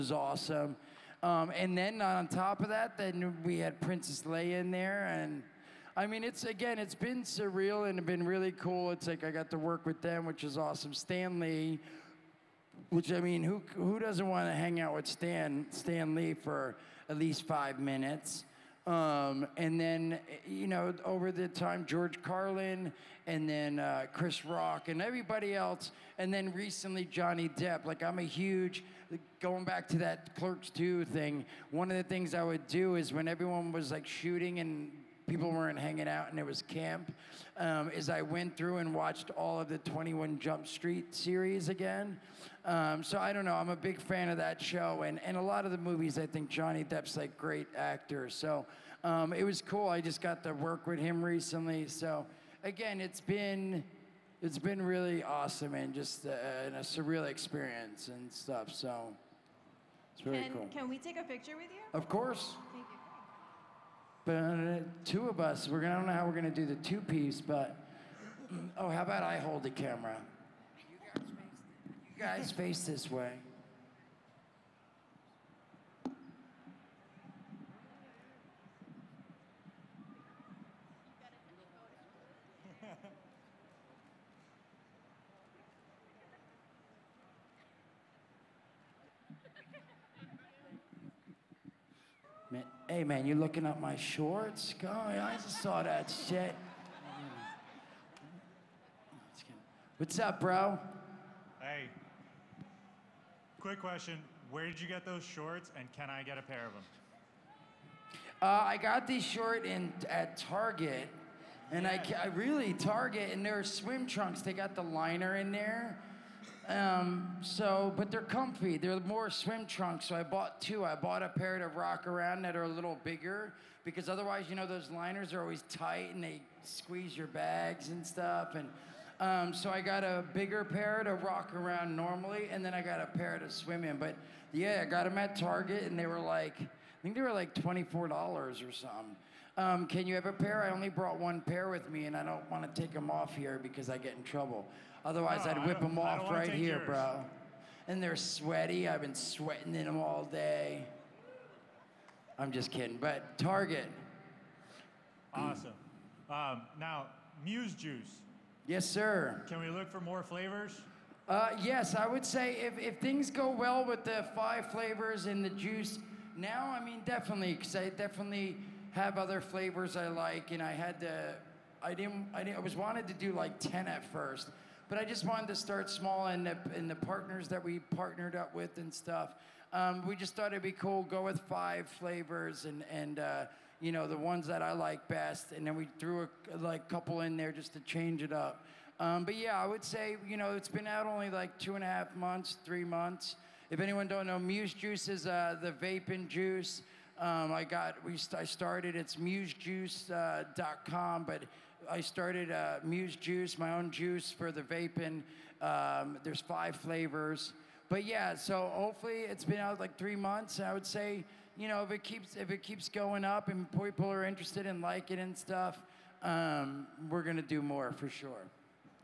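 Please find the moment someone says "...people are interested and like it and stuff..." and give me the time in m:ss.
3:33.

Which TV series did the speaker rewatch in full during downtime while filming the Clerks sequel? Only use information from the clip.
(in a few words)
21 Jump Street.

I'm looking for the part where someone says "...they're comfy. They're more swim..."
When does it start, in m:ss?
1:58.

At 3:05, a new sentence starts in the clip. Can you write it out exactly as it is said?
And then we threw a like couple in there just to change it up.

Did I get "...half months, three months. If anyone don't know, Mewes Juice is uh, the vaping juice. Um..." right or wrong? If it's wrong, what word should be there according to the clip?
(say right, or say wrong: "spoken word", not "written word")
right.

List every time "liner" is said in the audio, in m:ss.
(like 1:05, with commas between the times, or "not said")
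1:54, 2:04.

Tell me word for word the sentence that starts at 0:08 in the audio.
It's like I got to work with them, which is awesome.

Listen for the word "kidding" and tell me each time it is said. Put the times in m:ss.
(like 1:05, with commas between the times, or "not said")
2:32.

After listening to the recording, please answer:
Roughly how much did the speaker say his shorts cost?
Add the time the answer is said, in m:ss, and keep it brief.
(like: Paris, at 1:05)
$24, at 2:17.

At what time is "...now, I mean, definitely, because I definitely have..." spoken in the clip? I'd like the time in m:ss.
2:46.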